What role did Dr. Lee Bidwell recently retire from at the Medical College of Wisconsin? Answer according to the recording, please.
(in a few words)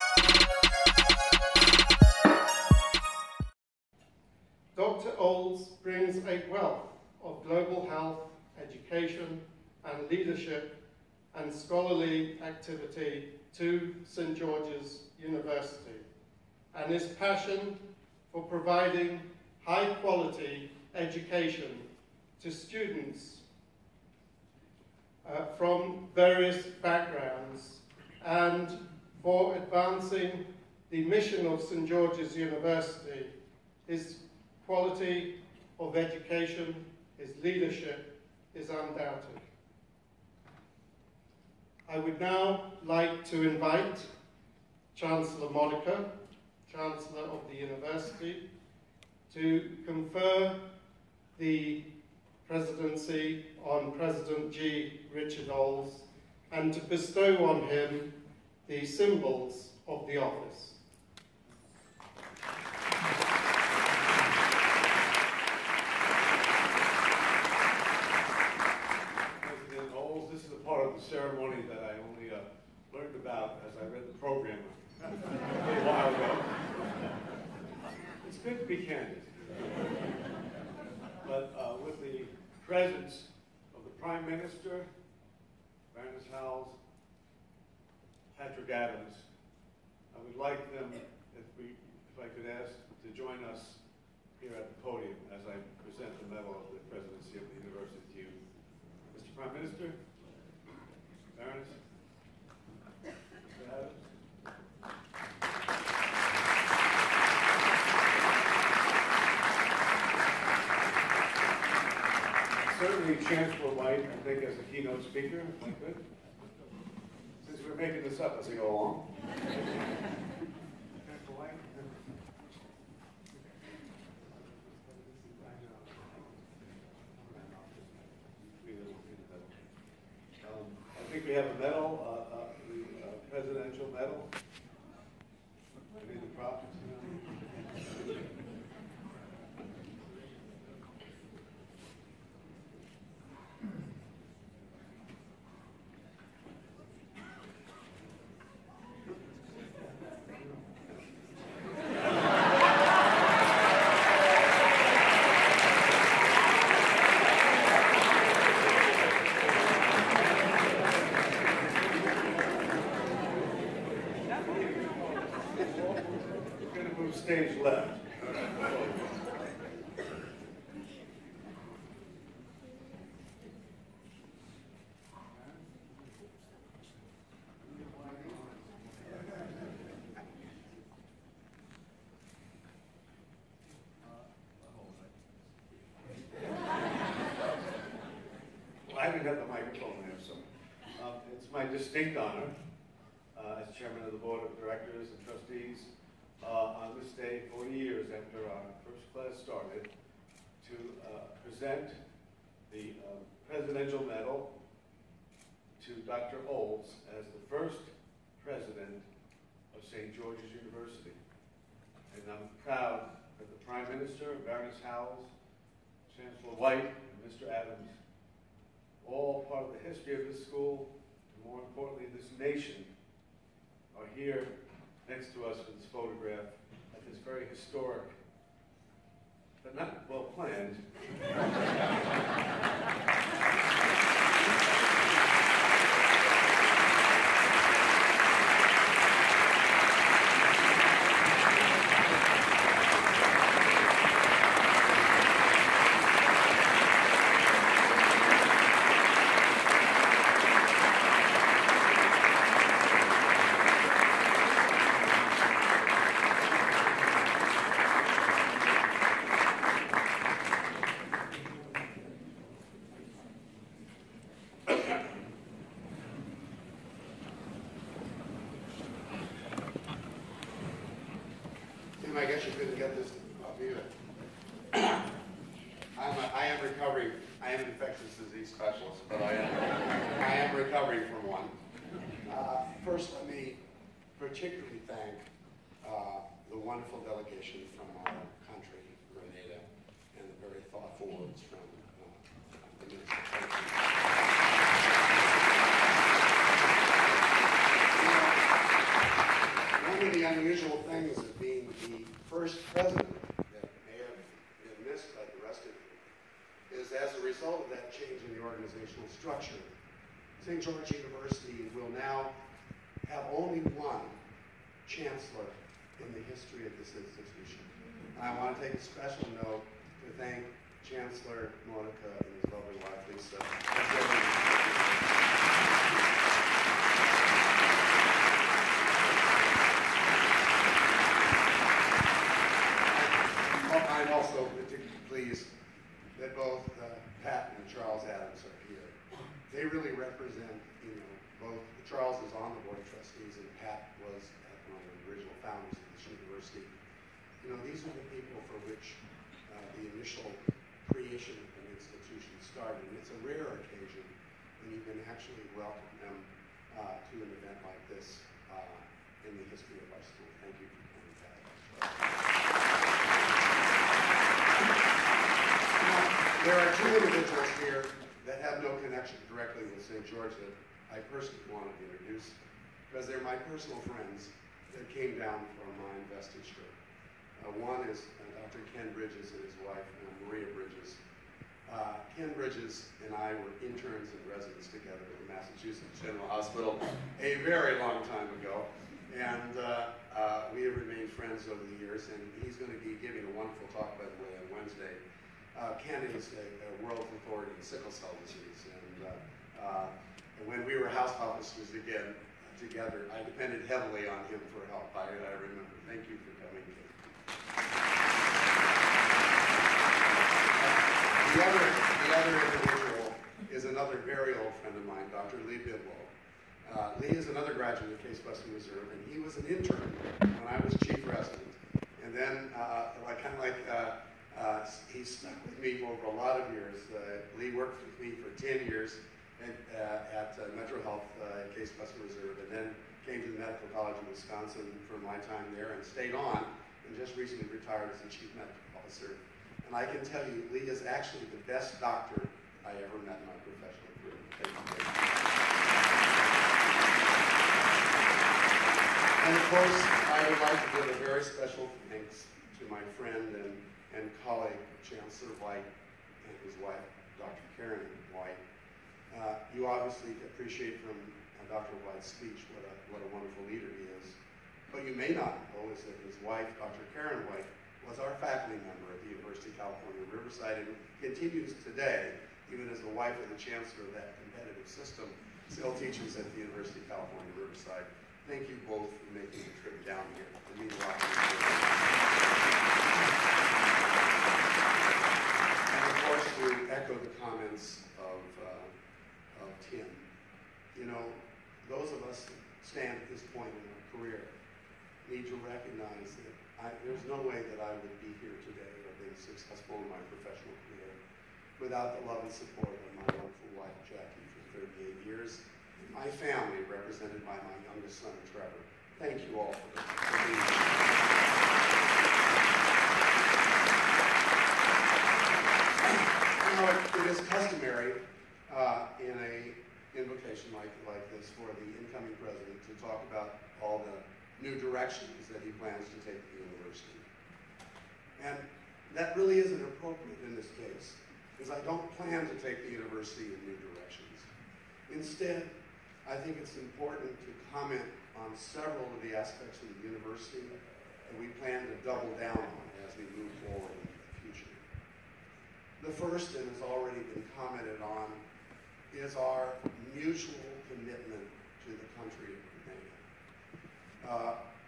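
Chief Medical Officer.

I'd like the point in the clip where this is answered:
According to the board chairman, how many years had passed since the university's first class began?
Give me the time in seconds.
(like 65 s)
197 s.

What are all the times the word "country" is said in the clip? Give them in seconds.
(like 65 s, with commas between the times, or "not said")
288 s, 551 s.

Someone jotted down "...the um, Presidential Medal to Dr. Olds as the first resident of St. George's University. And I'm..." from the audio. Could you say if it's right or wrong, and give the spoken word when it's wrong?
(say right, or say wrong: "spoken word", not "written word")
wrong: "president", not "resident".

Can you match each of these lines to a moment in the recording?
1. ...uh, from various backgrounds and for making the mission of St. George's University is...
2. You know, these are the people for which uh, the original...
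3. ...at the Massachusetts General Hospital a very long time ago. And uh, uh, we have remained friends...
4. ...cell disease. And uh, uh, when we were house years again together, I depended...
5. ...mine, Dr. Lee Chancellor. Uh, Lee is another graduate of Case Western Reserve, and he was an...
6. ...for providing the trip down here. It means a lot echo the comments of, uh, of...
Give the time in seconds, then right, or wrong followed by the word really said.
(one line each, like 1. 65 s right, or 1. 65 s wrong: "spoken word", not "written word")
1. 25 s wrong: "advancing", not "making"
2. 347 s wrong: "initial", not "original"
3. 385 s right
4. 397 s wrong: "officers", not "years"
5. 414 s wrong: "Bidwell", not "Chancellor"
6. 478 s wrong: "making", not "providing".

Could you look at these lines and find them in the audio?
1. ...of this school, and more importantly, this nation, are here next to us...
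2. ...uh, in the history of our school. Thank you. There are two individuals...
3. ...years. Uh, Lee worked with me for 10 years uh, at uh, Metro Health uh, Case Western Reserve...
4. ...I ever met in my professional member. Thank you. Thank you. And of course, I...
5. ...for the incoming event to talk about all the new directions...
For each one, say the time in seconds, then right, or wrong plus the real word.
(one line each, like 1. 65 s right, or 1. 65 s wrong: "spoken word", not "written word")
1. 220 s right
2. 358 s right
3. 426 s right
4. 442 s wrong: "career", not "member"
5. 521 s wrong: "president", not "event".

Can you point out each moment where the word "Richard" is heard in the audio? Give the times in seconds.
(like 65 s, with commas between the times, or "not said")
55 s.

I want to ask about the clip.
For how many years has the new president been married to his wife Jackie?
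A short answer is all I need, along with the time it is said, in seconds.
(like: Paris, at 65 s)
38, at 504 s.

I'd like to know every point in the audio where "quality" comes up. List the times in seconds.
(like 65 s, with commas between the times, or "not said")
20 s, 34 s.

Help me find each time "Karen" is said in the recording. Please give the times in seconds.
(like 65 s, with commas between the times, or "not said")
457 s, 466 s.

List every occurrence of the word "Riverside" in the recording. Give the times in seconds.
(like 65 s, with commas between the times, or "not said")
470 s, 477 s.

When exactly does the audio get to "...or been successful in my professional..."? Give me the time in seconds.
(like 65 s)
498 s.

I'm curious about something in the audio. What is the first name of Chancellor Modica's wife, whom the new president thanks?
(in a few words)
Lisa.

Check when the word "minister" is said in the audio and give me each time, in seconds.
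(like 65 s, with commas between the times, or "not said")
84 s, 99 s, 213 s, 292 s.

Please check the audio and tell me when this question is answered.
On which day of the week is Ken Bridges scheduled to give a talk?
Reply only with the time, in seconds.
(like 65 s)
394 s.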